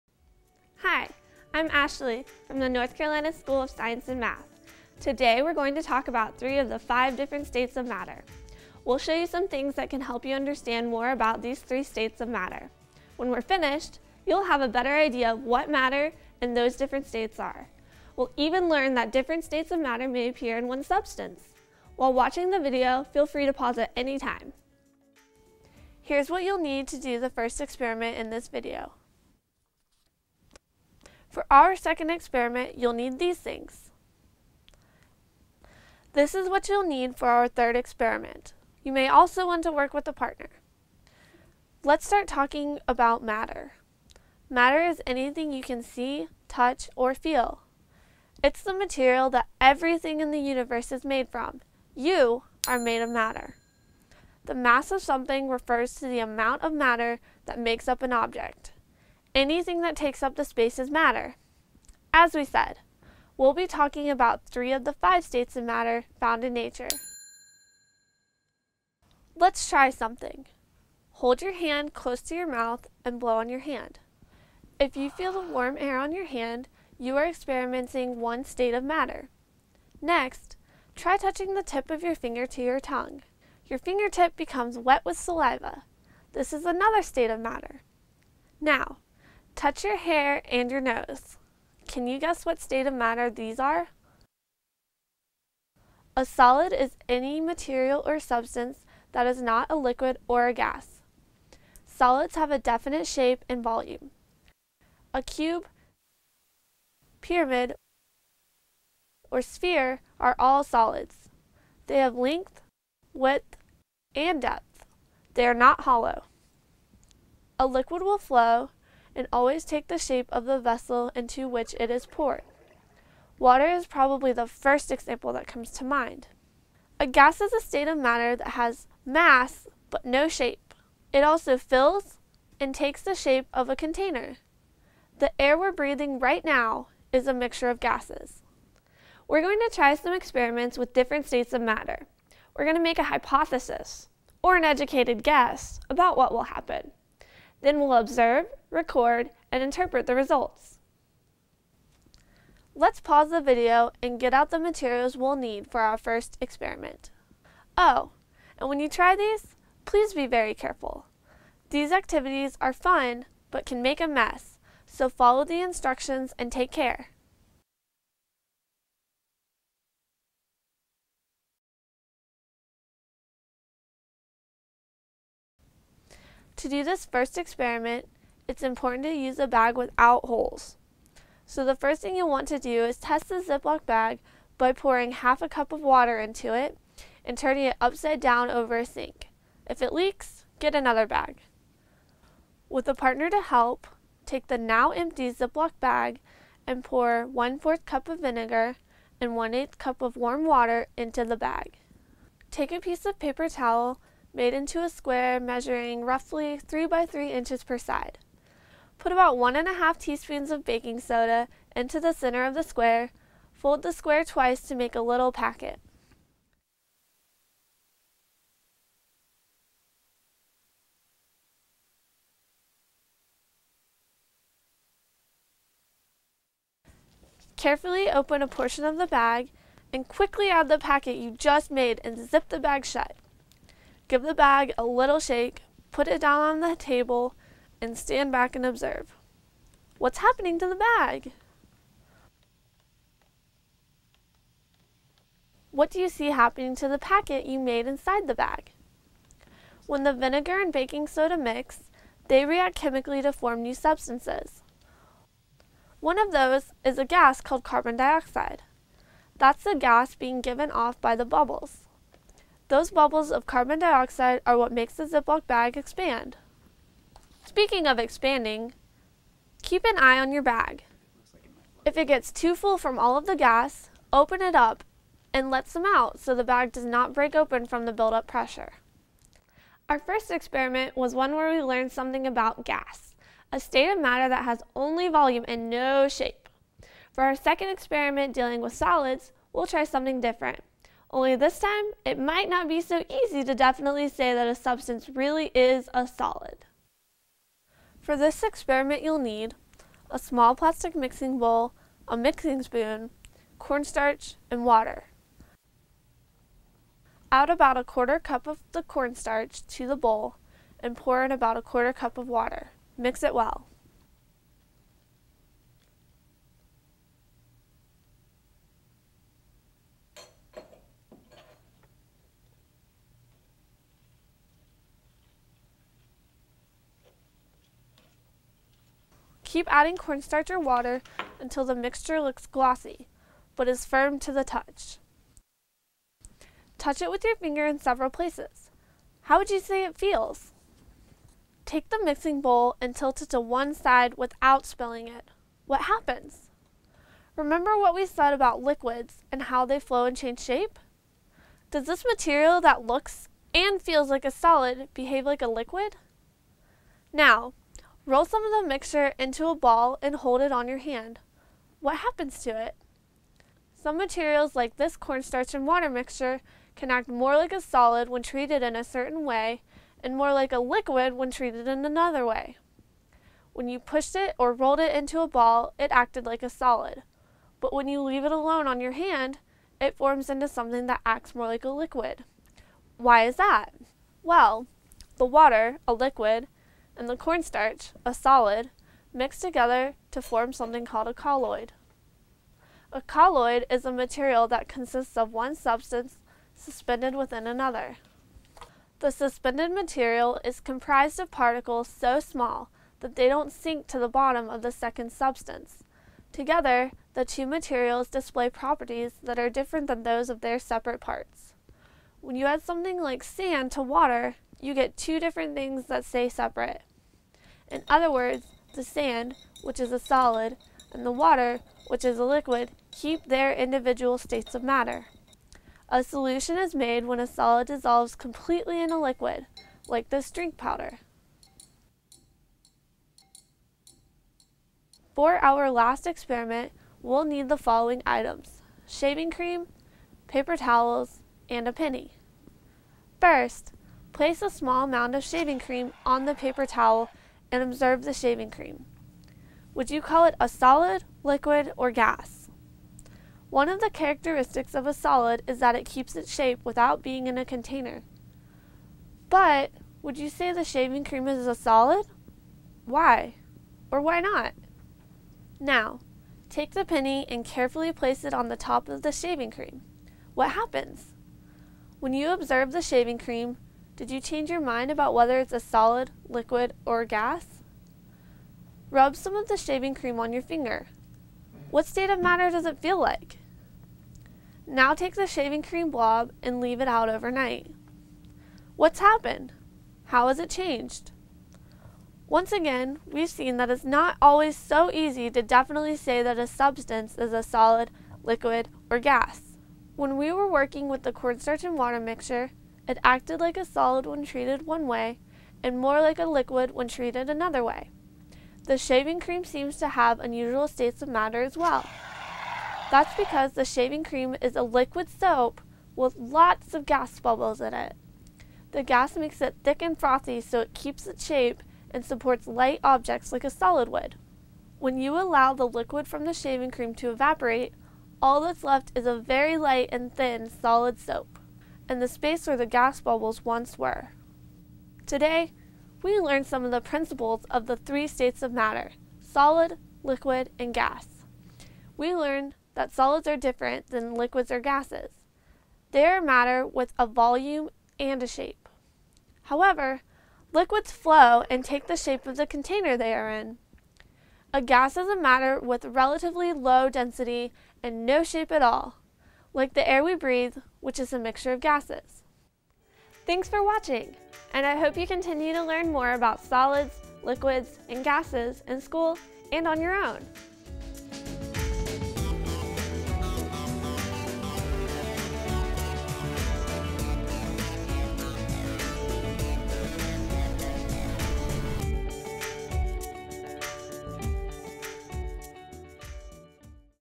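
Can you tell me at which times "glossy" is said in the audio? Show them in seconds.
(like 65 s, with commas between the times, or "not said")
332 s.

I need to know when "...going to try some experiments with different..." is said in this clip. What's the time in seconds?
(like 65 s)
139 s.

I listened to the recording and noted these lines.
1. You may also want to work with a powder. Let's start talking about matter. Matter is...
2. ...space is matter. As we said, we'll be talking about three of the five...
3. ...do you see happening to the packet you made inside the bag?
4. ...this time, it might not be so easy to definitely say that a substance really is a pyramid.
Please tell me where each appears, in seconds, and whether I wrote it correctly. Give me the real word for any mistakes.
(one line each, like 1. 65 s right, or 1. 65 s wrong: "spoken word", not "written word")
1. 38 s wrong: "partner", not "powder"
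2. 60 s right
3. 245 s right
4. 291 s wrong: "solid", not "pyramid".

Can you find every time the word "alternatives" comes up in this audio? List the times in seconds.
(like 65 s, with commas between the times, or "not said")
not said.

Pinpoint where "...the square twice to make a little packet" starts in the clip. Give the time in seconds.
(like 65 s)
213 s.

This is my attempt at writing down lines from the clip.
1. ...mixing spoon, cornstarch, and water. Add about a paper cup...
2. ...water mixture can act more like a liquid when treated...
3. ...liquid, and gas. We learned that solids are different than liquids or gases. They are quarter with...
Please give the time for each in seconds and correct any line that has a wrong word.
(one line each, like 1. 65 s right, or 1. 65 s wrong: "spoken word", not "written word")
1. 302 s wrong: "quarter", not "paper"
2. 365 s wrong: "solid", not "liquid"
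3. 540 s wrong: "matter", not "quarter".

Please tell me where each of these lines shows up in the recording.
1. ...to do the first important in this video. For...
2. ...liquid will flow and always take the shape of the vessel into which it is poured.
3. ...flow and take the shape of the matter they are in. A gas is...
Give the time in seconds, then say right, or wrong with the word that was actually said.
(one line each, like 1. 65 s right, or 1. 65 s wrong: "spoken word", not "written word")
1. 26 s wrong: "experiment", not "important"
2. 117 s right
3. 550 s wrong: "container", not "matter".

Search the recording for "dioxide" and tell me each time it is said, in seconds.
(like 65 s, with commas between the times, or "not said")
257 s, 263 s.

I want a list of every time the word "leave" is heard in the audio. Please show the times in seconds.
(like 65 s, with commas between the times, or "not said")
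378 s, 486 s.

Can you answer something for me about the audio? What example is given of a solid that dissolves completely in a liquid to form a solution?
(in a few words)
drink powder.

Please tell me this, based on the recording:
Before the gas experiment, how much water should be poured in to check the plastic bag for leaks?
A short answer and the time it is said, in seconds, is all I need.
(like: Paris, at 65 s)
half a cup, at 185 s.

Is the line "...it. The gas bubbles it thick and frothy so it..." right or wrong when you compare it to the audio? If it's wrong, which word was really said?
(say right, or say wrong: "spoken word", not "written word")
wrong: "makes", not "bubbles".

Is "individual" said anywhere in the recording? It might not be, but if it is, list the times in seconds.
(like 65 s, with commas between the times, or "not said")
423 s.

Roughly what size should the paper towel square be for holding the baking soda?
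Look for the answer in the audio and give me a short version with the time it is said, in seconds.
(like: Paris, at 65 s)
3 by 3 inches, at 206 s.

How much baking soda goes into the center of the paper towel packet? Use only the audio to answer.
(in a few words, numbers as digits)
1.5 teaspoons.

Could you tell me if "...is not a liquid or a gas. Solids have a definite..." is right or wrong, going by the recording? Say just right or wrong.
right.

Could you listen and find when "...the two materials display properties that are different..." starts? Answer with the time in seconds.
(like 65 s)
407 s.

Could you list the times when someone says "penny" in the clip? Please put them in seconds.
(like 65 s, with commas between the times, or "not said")
441 s, 466 s.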